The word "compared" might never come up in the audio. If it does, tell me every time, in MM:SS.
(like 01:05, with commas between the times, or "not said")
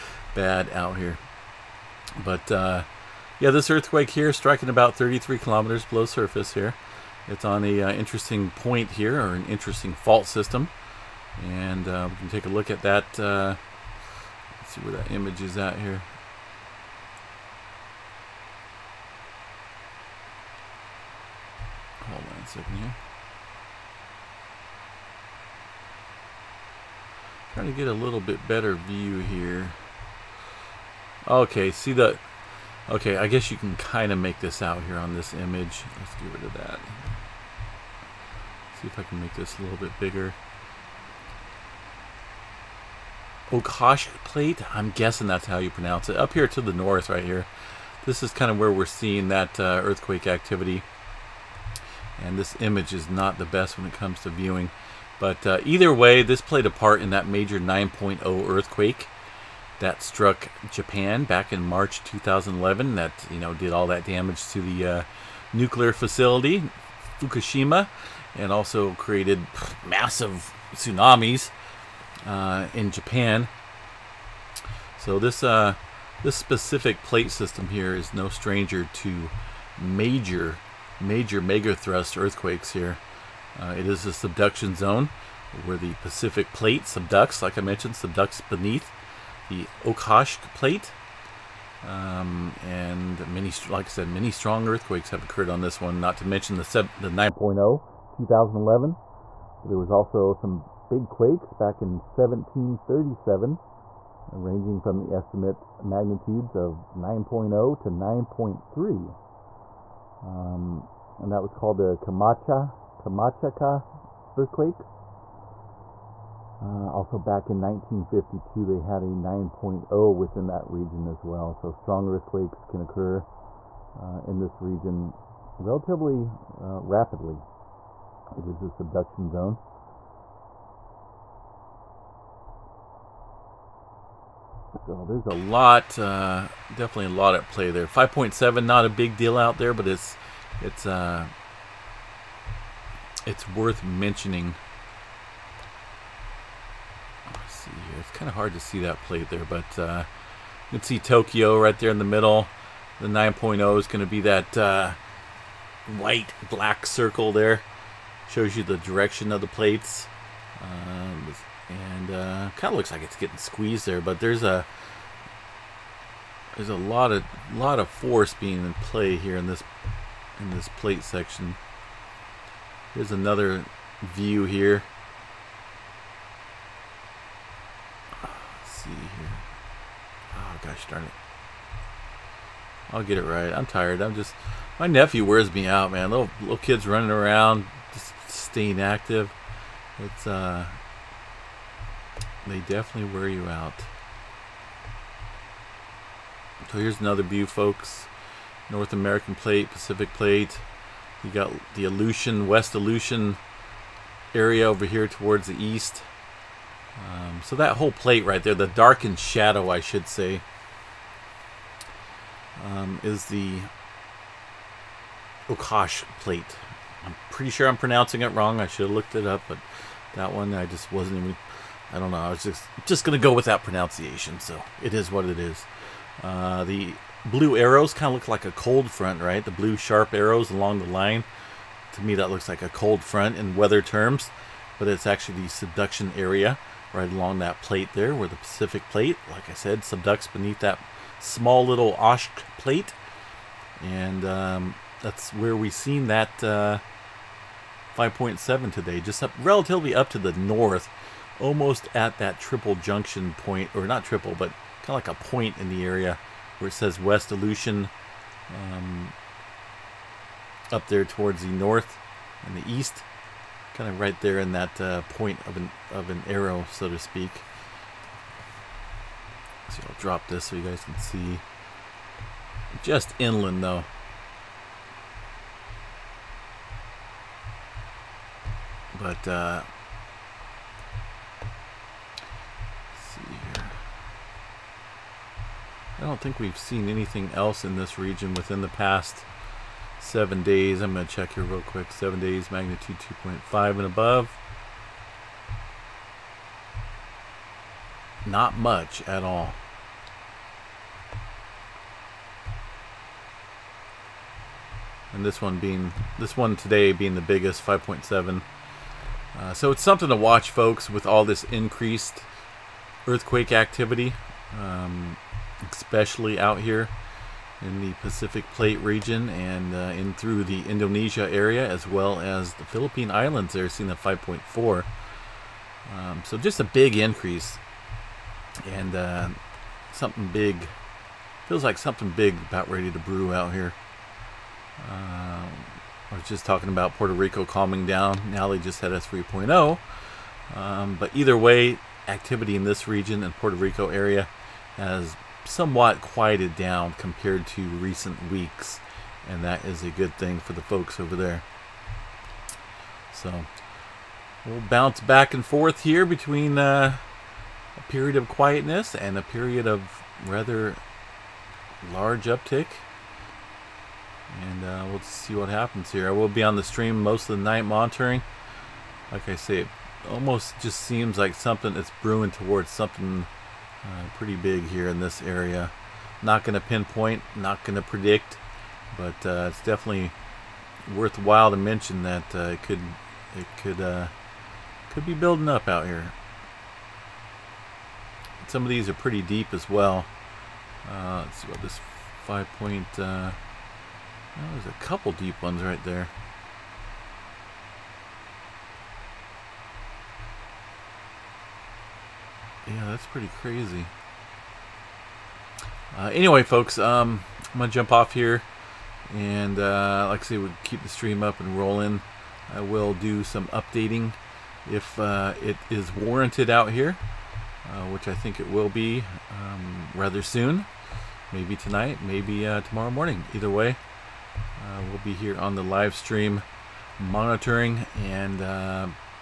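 05:46.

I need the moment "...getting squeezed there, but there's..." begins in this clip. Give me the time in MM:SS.
02:43.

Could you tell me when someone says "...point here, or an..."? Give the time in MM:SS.
00:08.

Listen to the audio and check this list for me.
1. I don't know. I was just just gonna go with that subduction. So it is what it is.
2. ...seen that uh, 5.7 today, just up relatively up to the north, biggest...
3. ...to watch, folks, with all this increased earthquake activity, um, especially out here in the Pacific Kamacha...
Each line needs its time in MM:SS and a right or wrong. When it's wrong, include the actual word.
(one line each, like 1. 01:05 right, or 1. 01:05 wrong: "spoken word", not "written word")
1. 03:41 wrong: "pronunciation", not "subduction"
2. 04:05 wrong: "almost", not "biggest"
3. 05:10 wrong: "Plate", not "Kamacha".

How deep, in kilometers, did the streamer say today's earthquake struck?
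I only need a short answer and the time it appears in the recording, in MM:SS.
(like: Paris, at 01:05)
33 kilometers, at 00:04.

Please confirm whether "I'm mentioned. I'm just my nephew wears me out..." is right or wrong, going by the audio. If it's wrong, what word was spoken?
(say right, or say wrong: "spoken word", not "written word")
wrong: "tired", not "mentioned".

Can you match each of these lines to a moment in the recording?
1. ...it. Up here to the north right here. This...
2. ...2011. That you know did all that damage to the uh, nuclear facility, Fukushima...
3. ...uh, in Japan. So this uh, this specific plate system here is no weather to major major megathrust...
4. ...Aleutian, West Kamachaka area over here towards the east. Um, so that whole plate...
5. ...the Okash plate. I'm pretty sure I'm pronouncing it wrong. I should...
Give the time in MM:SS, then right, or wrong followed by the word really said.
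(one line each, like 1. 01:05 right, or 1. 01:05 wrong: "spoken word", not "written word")
1. 00:46 right
2. 01:02 right
3. 01:12 wrong: "stranger", not "weather"
4. 03:21 wrong: "Aleutian", not "Kamachaka"
5. 03:33 right.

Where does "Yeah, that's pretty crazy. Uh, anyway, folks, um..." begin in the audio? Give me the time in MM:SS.
06:42.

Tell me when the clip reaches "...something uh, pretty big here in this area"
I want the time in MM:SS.
06:12.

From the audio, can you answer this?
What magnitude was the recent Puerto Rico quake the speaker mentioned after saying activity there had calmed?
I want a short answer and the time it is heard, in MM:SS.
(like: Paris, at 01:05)
3.0, at 05:38.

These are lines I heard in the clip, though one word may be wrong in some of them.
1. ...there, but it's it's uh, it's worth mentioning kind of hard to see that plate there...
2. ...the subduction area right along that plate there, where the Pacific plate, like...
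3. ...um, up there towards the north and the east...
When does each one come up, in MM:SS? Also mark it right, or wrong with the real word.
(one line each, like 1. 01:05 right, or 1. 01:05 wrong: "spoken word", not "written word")
1. 02:19 right
2. 03:55 right
3. 04:18 right.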